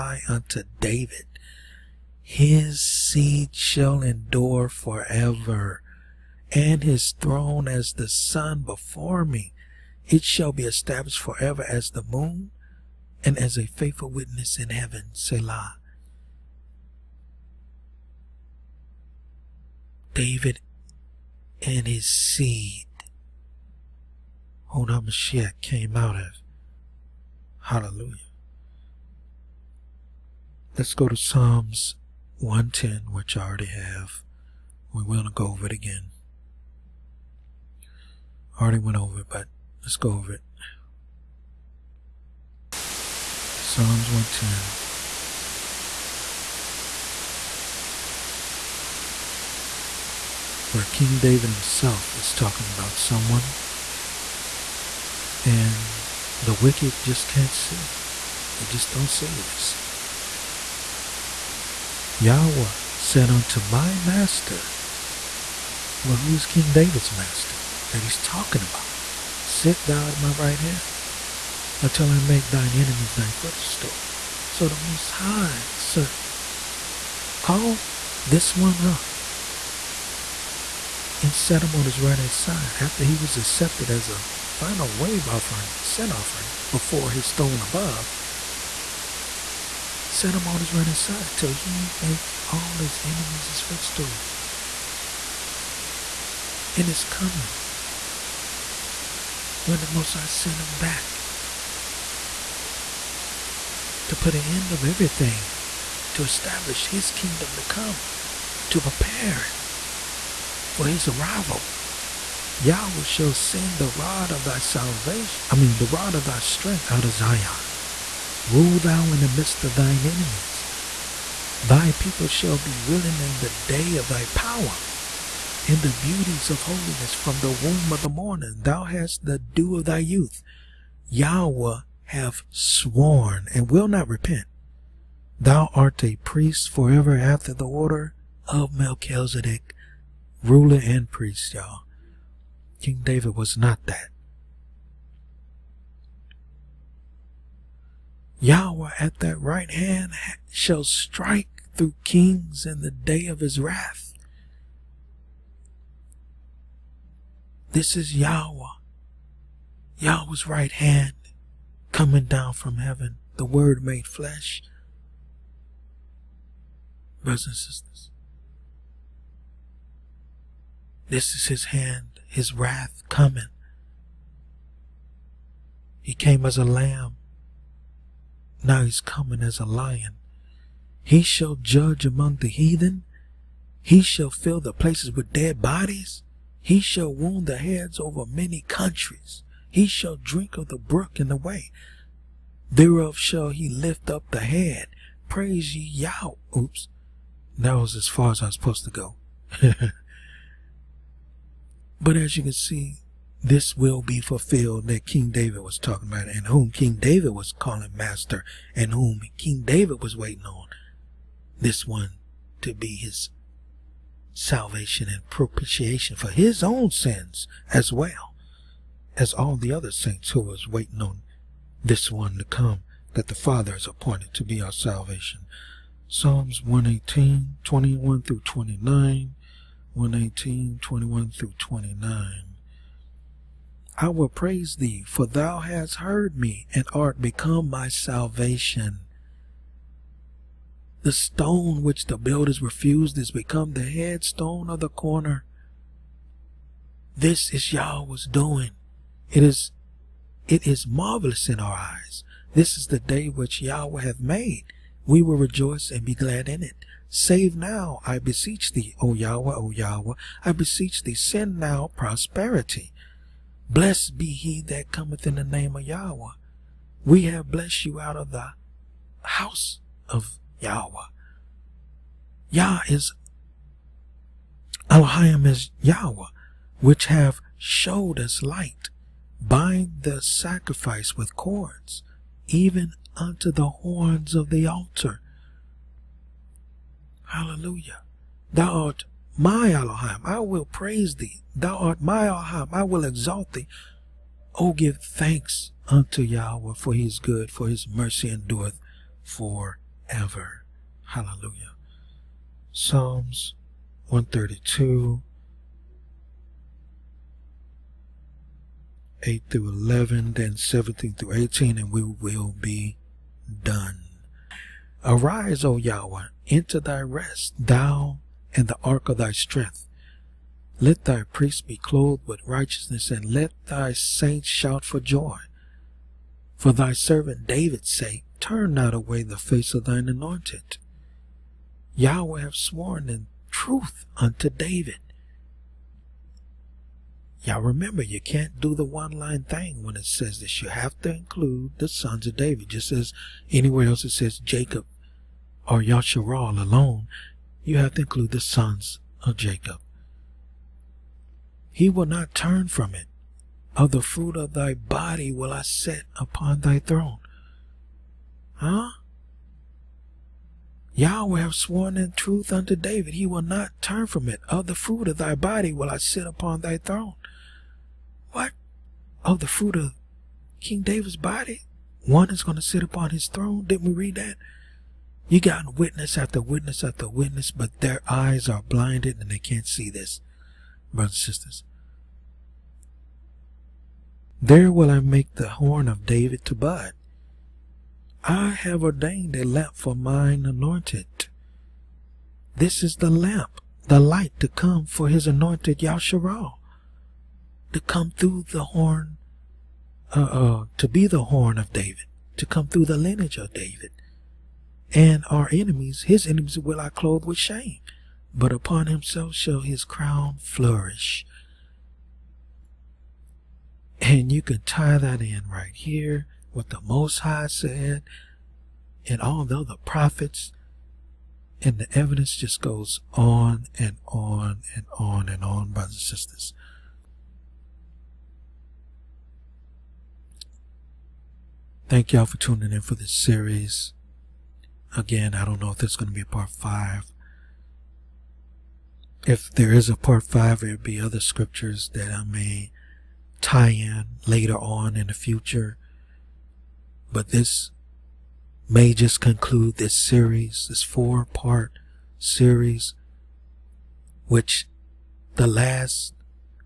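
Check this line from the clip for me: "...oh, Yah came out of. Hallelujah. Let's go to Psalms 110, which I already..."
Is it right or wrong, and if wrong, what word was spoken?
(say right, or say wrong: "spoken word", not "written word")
wrong: "HaMashiach", not "Yah".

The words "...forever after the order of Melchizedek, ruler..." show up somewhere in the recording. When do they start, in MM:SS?
02:16.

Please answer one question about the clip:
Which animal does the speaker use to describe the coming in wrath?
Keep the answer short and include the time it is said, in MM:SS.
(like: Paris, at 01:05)
A lion, at 02:59.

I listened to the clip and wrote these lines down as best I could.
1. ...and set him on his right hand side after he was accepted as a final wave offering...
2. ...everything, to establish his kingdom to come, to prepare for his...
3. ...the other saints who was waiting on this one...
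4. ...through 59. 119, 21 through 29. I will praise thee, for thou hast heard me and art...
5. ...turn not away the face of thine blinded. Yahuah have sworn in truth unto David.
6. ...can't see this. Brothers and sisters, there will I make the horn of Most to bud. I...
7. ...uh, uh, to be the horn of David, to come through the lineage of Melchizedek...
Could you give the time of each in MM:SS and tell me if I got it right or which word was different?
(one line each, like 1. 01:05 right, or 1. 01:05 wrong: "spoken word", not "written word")
1. 01:21 right
2. 01:44 right
3. 03:39 right
4. 03:48 wrong: "29", not "59"
5. 05:28 wrong: "anointed", not "blinded"
6. 06:19 wrong: "David", not "Most"
7. 06:40 wrong: "David", not "Melchizedek".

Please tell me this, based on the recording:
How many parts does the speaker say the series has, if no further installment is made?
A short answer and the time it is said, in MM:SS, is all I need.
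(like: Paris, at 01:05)
4, at 07:30.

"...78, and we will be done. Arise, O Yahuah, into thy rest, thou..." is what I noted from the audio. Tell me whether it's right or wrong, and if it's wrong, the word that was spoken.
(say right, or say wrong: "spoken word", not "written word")
wrong: "18", not "78".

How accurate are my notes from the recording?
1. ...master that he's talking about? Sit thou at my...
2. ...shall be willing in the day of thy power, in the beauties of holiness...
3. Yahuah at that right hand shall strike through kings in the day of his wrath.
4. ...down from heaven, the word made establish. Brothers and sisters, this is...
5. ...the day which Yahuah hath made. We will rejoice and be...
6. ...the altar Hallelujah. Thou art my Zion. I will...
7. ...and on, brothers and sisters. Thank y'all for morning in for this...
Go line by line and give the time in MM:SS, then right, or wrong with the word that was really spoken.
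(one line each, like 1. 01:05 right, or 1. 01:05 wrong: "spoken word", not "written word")
1. 01:07 right
2. 02:02 right
3. 02:28 right
4. 02:42 wrong: "flesh", not "establish"
5. 04:12 right
6. 04:44 wrong: "Elohim", not "Zion"
7. 07:05 wrong: "tuning", not "morning".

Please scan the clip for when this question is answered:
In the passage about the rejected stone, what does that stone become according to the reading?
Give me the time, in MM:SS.
04:03.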